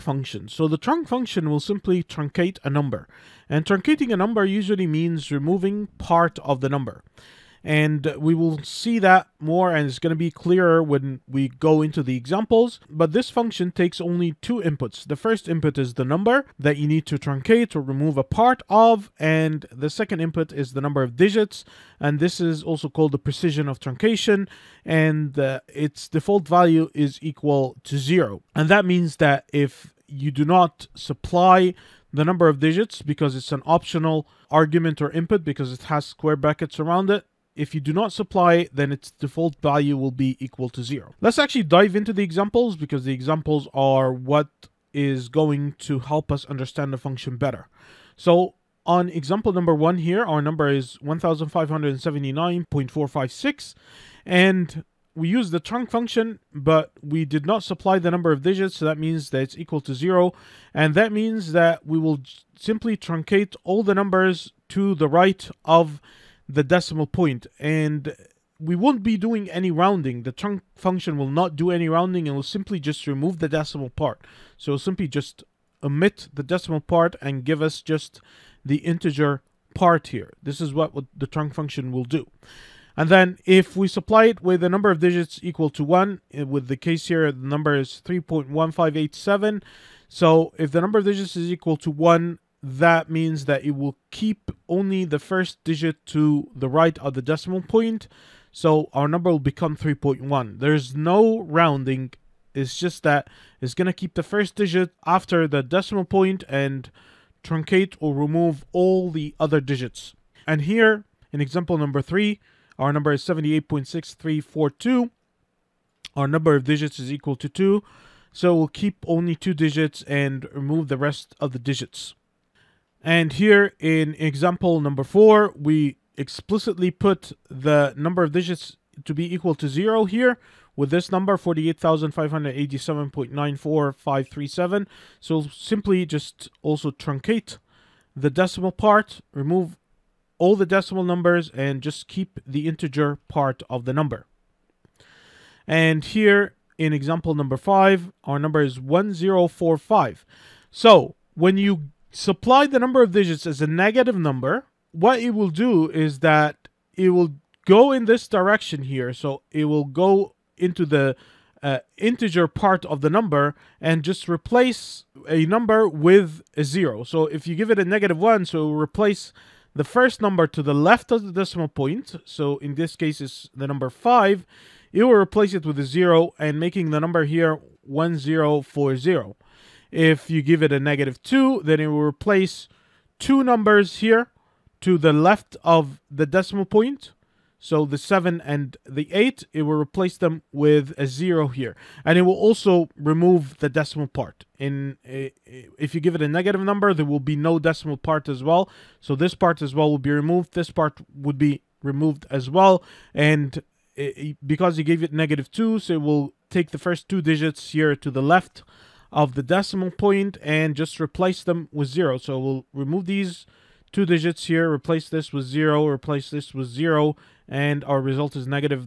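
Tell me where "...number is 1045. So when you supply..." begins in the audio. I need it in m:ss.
2:28.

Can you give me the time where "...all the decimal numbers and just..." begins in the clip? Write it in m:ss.
2:20.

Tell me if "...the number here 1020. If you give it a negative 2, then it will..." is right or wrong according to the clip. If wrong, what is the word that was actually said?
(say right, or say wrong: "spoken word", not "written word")
wrong: "1040", not "1020".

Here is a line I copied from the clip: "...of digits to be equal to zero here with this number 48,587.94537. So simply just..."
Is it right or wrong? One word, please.
right.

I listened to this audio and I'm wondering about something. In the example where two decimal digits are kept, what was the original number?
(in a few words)
78.6342.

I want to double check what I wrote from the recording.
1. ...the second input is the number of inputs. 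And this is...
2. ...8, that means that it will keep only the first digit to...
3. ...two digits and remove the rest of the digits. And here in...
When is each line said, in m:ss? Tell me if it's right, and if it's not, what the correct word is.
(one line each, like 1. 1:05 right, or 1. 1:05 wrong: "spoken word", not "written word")
1. 0:19 wrong: "digits", not "inputs"
2. 1:31 wrong: "1", not "8"
3. 1:59 right.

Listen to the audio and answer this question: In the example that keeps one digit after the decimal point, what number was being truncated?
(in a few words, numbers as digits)
3.1587.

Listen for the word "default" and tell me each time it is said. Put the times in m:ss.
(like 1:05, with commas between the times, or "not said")
0:26, 0:39.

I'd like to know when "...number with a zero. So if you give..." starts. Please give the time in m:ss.
2:45.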